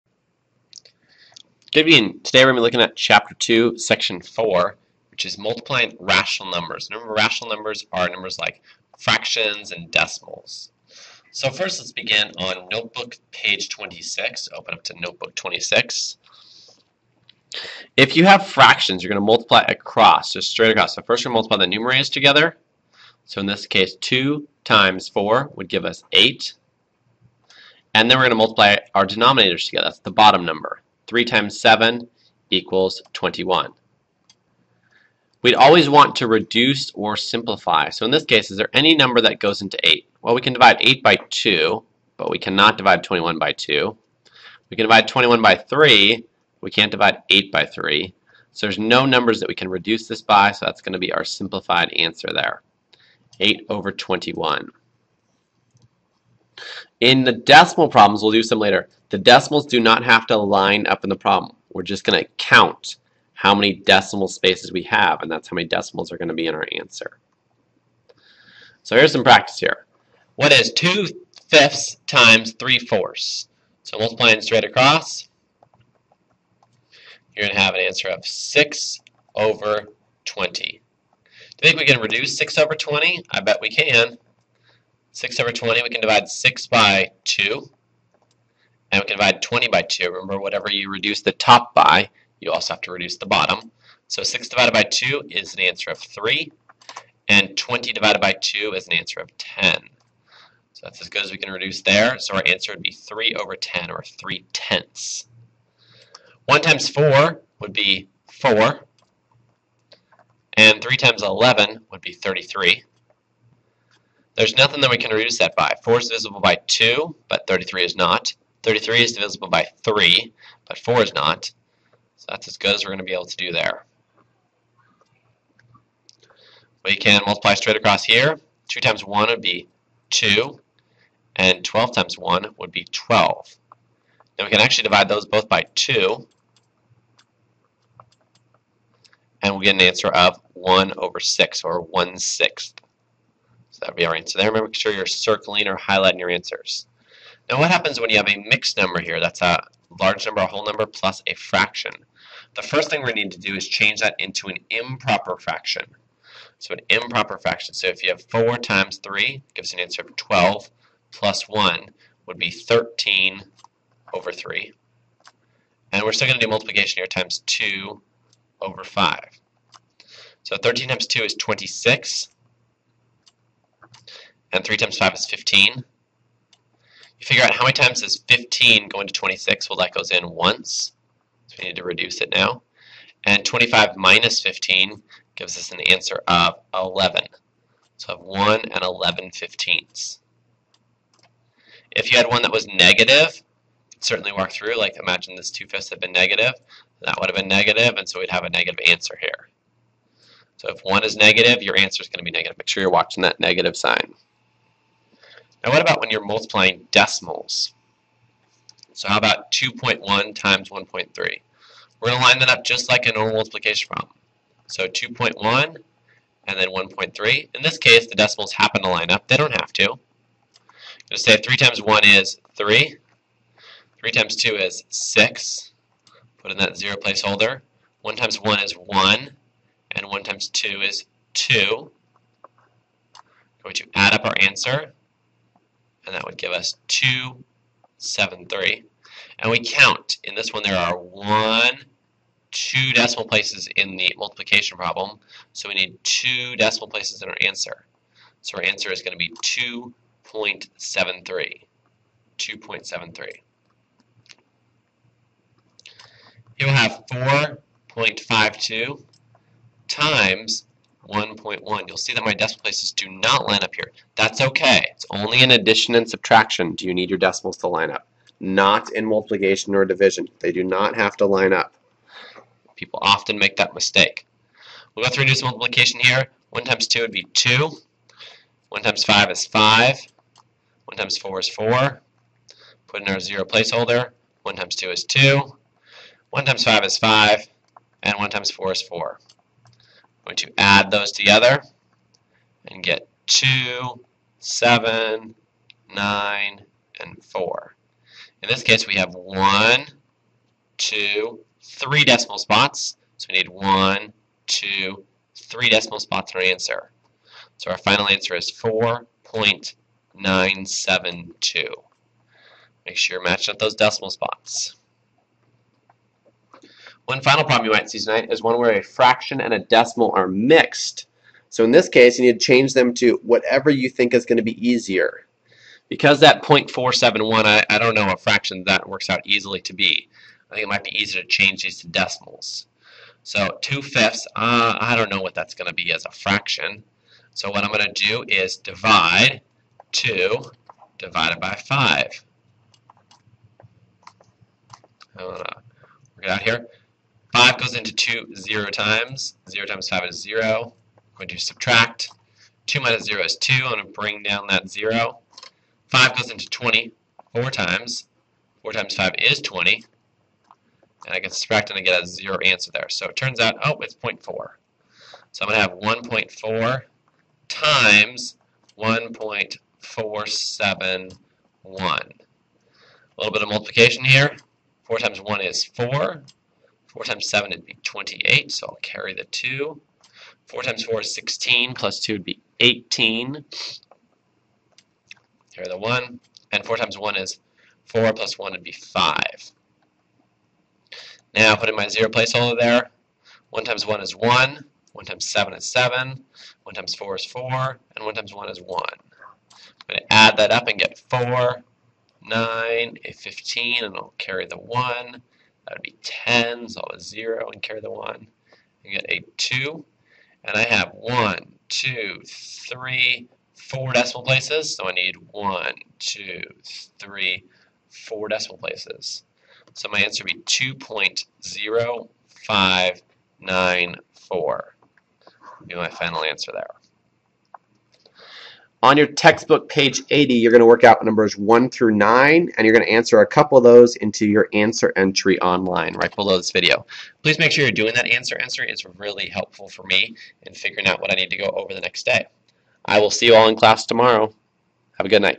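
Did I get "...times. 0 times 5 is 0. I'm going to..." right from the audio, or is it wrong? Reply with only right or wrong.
right.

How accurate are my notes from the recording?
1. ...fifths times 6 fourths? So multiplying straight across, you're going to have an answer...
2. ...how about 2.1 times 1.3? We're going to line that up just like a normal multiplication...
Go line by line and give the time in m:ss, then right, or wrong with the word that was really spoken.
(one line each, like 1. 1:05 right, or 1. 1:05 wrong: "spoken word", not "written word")
1. 1:11 wrong: "3", not "6"
2. 3:29 right.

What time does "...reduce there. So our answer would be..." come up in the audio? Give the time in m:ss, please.
1:41.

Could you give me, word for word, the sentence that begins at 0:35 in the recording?
We'd always want to reduce or simplify.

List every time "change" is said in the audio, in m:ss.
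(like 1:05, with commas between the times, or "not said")
2:33, 5:22, 5:31.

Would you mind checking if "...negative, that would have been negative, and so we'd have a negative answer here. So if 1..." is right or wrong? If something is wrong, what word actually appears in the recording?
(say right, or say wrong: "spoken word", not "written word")
right.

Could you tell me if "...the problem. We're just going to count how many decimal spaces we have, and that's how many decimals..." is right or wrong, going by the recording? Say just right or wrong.
right.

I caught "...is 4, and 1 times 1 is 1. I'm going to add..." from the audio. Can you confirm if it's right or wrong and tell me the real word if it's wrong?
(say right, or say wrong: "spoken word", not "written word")
right.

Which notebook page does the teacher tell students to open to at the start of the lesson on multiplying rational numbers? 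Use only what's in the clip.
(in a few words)
26.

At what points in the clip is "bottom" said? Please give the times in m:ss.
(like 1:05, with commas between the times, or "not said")
0:30, 1:33.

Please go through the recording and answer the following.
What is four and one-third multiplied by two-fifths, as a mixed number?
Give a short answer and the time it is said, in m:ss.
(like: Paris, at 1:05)
1 and 11/15, at 3:08.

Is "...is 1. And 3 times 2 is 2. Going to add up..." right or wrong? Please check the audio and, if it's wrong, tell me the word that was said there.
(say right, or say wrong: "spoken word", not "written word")
wrong: "1", not "3".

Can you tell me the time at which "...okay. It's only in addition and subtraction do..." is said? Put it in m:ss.
4:24.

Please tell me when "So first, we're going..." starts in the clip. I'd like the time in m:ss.
0:20.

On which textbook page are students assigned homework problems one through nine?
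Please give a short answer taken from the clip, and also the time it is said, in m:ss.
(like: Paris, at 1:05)
80, at 7:09.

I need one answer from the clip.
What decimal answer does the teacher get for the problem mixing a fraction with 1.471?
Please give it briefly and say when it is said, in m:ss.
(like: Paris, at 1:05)
2.0594, at 7:00.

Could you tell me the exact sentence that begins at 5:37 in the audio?
So what I'm going to do is divide 2 divided by 5.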